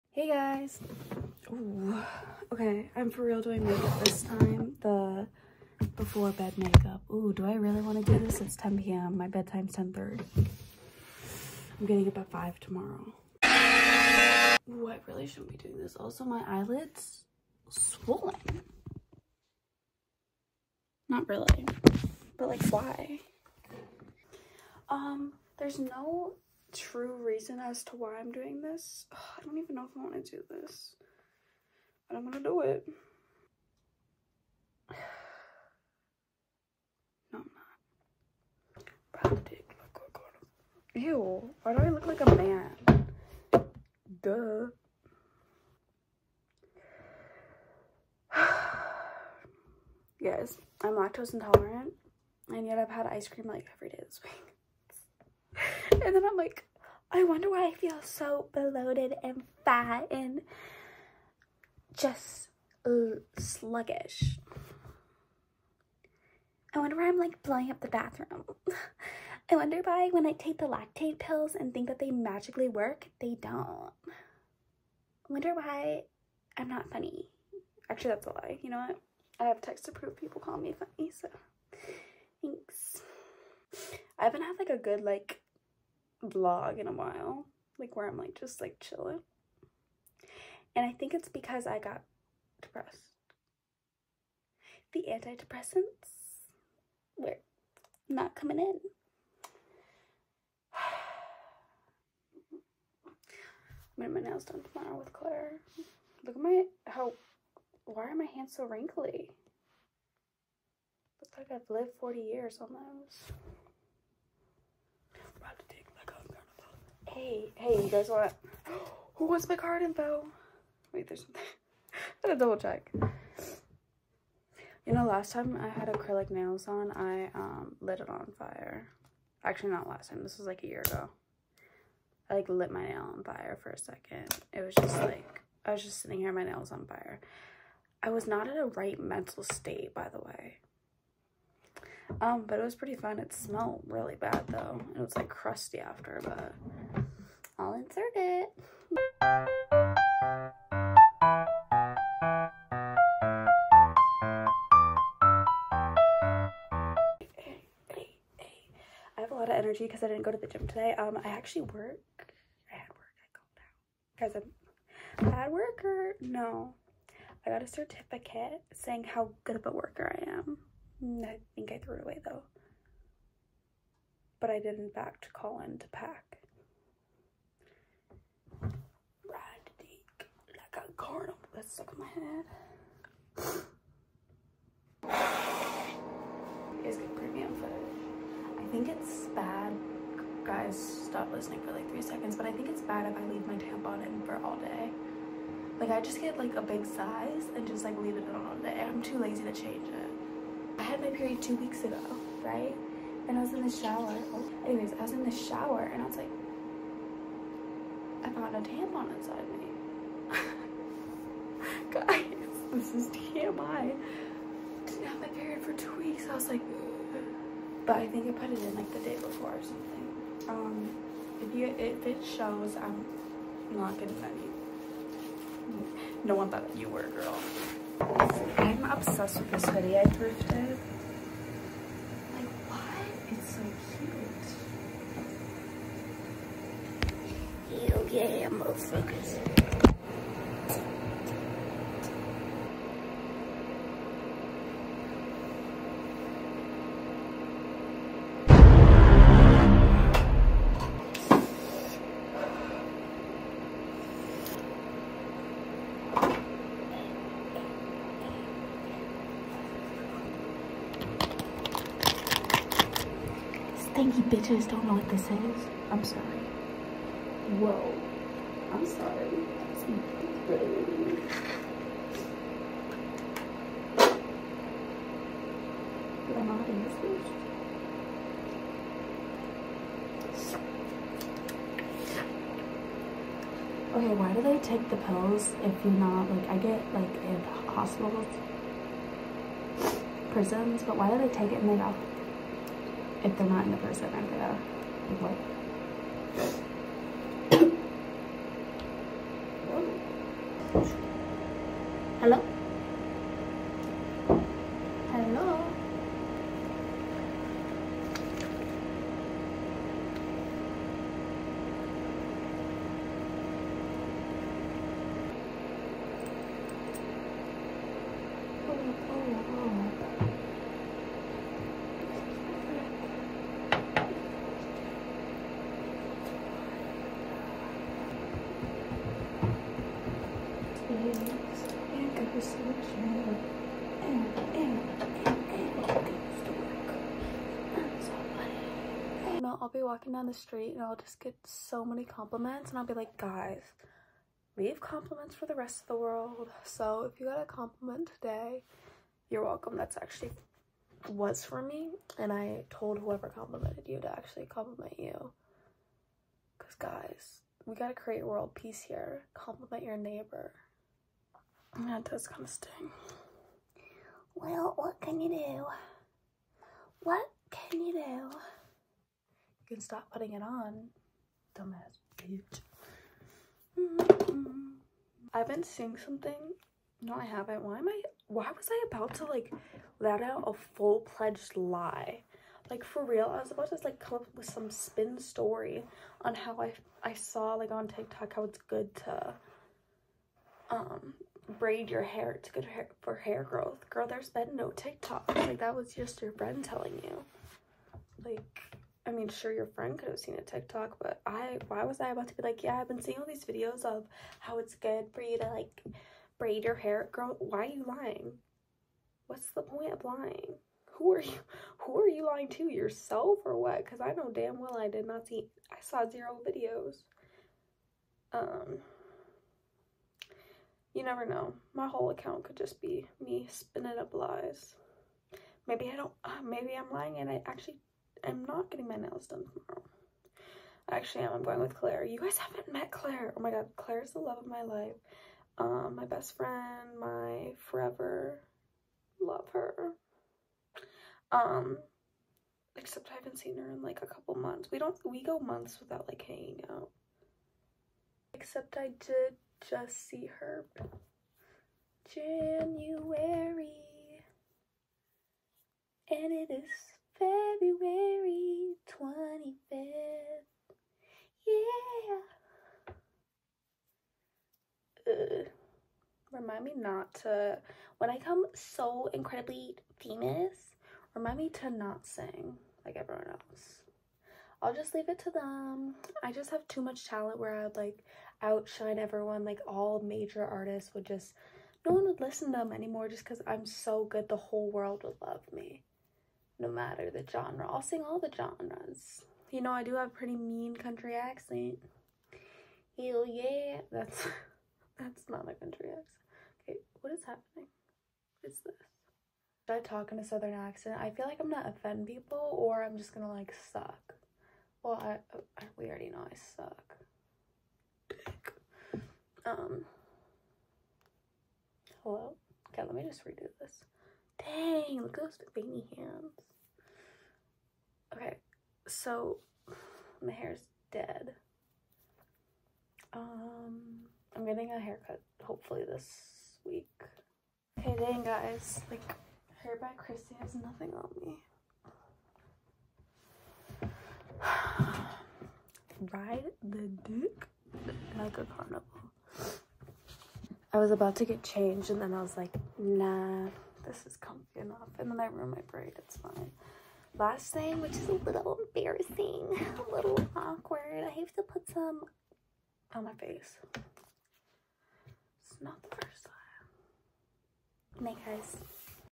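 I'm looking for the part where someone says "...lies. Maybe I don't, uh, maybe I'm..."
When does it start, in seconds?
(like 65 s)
424 s.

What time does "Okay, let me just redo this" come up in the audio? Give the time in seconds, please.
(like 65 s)
512 s.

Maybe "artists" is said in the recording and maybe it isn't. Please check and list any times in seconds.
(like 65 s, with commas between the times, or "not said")
480 s.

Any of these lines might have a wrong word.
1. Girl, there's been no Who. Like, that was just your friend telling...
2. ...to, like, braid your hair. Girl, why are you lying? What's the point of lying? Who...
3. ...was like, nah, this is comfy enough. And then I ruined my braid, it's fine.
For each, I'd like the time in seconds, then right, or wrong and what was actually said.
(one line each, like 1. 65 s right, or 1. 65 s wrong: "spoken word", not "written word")
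1. 393 s wrong: "TikTok", not "Who"
2. 405 s right
3. 542 s right.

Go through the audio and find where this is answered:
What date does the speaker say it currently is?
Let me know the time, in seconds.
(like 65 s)
457 s.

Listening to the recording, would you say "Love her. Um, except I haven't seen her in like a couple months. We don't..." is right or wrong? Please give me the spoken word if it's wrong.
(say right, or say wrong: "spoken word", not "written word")
right.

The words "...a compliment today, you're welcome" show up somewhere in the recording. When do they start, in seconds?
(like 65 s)
347 s.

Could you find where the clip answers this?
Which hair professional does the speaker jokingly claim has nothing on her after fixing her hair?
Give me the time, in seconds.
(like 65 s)
529 s.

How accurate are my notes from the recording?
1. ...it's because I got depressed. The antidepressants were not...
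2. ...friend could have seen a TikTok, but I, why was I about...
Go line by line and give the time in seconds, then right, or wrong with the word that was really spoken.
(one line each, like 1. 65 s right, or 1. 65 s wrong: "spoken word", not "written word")
1. 91 s right
2. 399 s right.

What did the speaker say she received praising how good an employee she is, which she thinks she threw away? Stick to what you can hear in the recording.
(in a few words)
A certificate.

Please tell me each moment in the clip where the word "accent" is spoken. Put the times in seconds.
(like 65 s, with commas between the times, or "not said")
491 s, 495 s, 500 s.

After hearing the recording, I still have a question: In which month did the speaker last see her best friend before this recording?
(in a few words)
January.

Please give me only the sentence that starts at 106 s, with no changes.
Look at my how why are my hands so wrinkly?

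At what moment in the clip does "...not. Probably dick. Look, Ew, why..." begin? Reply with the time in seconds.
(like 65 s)
38 s.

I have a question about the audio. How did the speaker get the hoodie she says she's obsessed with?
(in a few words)
Thrifted.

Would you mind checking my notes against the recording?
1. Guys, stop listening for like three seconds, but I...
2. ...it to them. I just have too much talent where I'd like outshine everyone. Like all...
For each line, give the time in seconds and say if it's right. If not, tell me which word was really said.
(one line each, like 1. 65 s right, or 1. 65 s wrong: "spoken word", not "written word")
1. 190 s right
2. 475 s right.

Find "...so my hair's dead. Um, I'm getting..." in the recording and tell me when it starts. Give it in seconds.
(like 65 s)
518 s.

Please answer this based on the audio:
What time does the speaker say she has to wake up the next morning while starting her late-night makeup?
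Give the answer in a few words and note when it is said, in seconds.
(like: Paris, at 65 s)
5, at 12 s.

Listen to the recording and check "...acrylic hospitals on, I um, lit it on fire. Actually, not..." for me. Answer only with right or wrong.
wrong.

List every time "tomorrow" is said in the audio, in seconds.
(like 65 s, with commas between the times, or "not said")
12 s, 104 s, 429 s.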